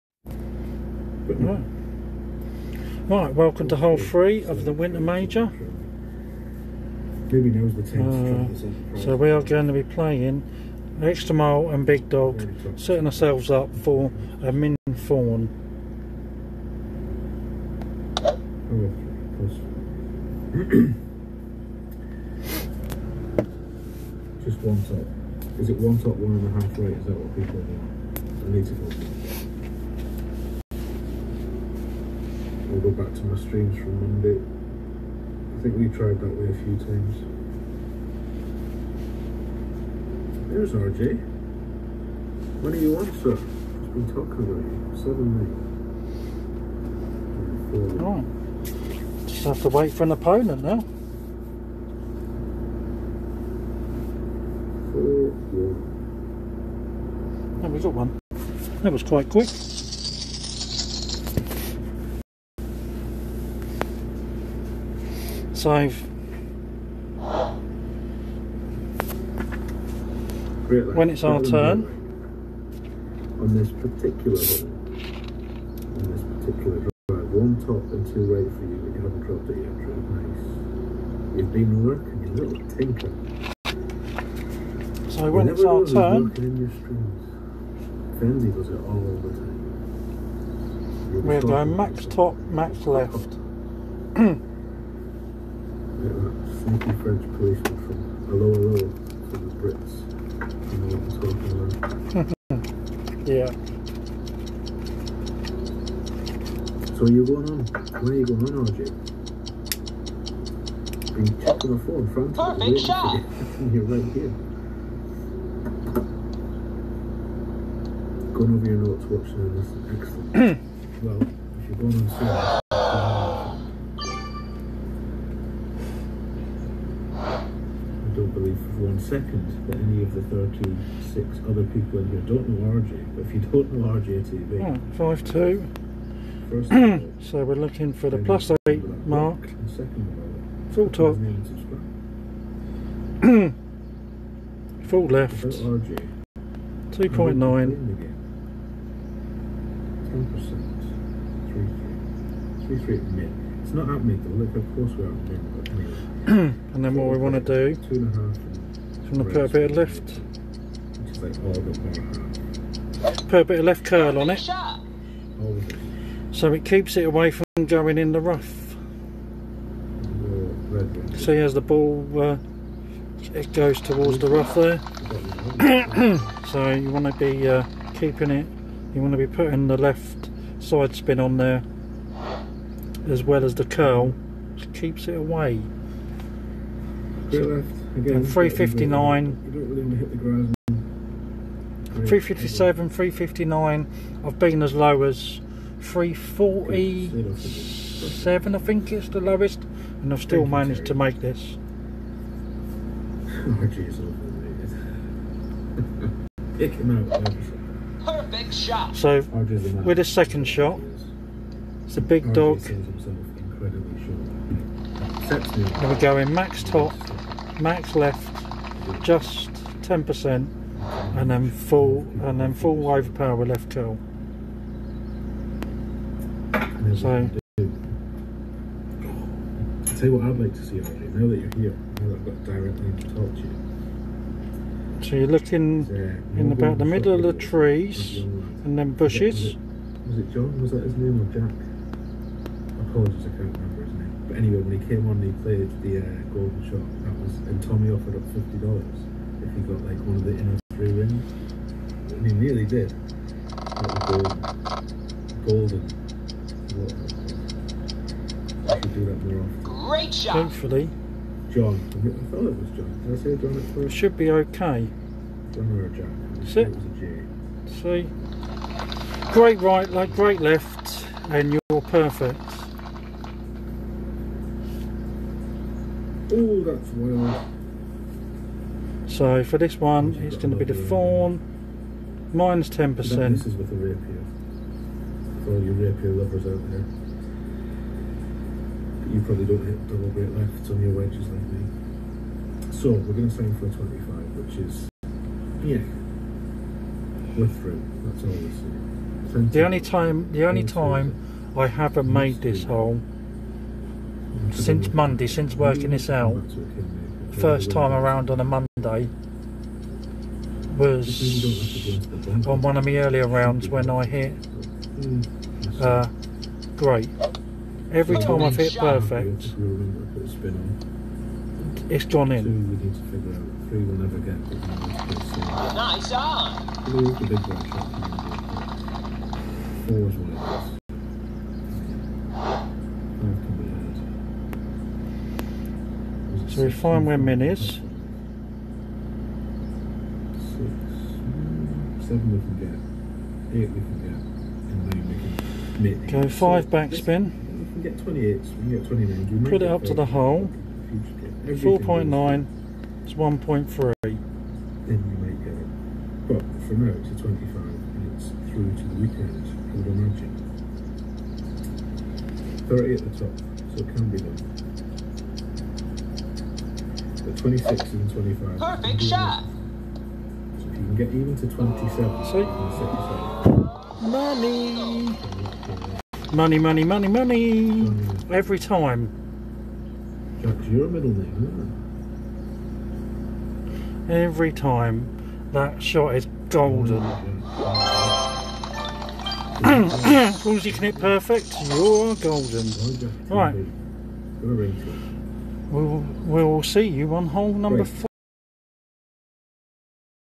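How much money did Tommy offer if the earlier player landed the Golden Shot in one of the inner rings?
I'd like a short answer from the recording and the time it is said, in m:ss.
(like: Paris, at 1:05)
50 dollars, at 4:08.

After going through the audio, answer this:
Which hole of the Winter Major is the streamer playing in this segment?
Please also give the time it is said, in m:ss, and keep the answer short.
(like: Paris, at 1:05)
hole three, at 0:03.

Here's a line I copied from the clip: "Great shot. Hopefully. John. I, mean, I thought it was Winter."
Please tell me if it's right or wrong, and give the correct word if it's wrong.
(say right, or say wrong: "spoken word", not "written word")
wrong: "John", not "Winter".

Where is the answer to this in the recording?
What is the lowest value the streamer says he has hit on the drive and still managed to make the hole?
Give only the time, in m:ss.
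3:15.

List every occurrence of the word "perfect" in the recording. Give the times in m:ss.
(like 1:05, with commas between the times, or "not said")
1:52, 3:28, 4:31, 5:18, 6:08, 6:30.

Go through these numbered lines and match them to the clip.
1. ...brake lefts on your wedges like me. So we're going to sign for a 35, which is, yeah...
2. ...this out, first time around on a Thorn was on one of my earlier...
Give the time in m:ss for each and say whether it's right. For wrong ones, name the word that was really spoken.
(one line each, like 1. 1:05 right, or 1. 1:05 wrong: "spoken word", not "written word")
1. 4:50 wrong: "25", not "35"
2. 5:05 wrong: "Monday", not "Thorn".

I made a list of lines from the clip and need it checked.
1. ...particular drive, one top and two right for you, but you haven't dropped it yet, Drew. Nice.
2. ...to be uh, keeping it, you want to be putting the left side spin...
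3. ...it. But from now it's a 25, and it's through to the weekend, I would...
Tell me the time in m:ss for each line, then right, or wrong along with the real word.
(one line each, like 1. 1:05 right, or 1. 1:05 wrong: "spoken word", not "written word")
1. 1:16 right
2. 2:57 right
3. 5:55 right.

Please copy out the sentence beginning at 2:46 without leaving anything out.
So it keeps it away from going in the rough.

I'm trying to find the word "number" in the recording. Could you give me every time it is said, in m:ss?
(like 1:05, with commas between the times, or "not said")
6:37.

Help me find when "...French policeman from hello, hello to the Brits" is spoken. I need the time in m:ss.
1:37.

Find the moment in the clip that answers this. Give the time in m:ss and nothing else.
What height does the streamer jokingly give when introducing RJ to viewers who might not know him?
2:14.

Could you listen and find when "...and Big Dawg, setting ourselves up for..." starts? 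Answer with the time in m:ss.
0:11.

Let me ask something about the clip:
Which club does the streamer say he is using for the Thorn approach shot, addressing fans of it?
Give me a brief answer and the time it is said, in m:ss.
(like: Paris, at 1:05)
the rapier, at 4:43.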